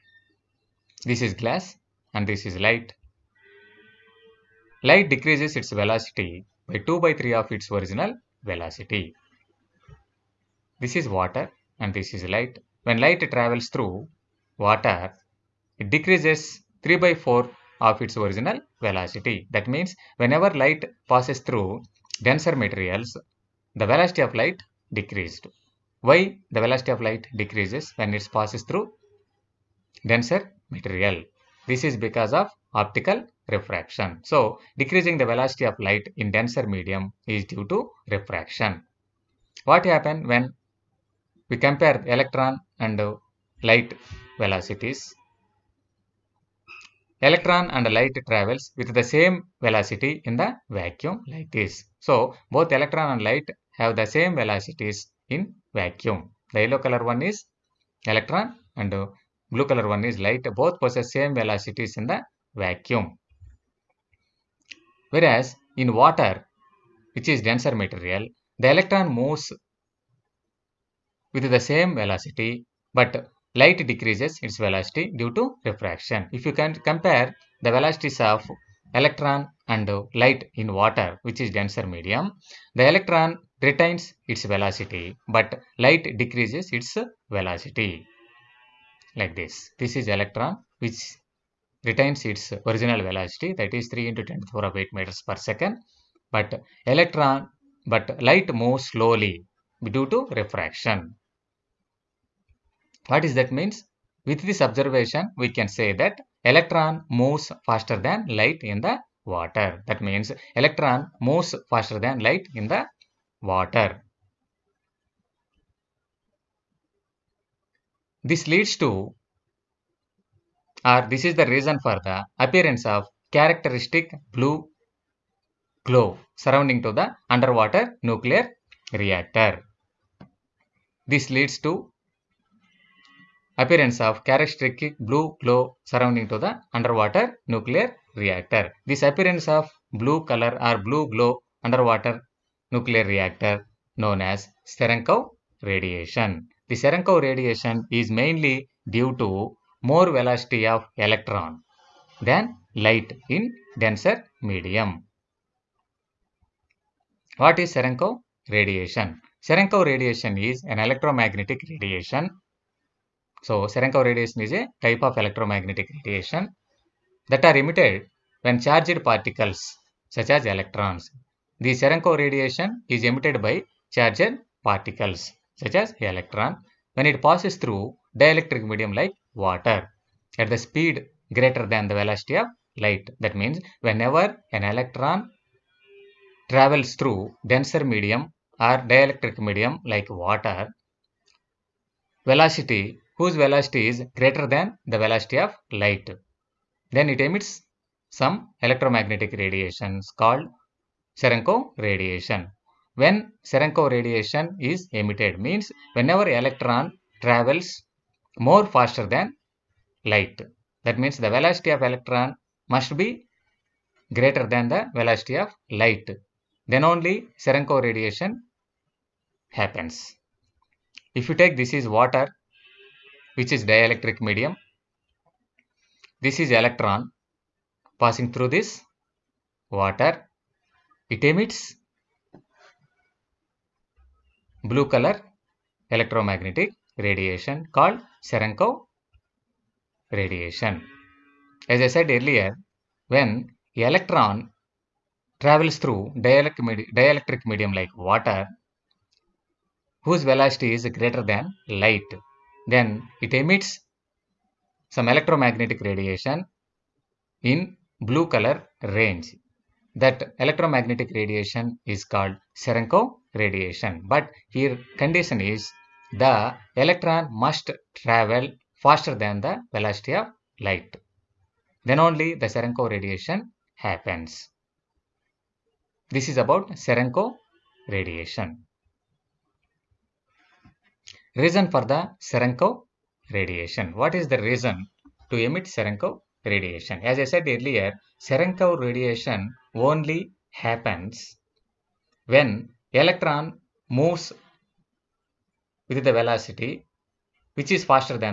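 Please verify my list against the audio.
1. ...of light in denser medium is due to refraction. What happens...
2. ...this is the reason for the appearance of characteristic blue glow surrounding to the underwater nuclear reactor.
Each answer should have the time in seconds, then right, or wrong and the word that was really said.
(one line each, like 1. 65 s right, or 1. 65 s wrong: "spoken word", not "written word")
1. 35 s right
2. 121 s right.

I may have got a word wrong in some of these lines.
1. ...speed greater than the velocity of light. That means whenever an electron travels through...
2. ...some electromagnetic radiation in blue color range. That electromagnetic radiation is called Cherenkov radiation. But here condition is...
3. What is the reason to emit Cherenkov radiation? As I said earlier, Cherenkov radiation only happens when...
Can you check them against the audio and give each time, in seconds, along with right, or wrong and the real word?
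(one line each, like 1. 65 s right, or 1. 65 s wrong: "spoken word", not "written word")
1. 180 s right
2. 254 s right
3. 283 s right.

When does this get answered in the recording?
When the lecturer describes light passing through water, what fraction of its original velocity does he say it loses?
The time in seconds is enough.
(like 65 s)
16 s.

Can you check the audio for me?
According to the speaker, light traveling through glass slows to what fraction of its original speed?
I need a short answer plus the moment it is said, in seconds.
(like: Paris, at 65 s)
2/3, at 6 s.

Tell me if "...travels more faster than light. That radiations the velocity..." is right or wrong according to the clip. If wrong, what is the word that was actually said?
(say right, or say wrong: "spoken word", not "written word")
wrong: "means", not "radiations".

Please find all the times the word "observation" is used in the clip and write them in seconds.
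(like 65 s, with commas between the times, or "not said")
104 s.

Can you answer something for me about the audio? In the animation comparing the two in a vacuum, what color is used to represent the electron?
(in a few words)
Yellow.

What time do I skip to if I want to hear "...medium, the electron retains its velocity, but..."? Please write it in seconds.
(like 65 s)
81 s.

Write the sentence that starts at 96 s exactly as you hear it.
But electron, but light moves slowly due to refraction.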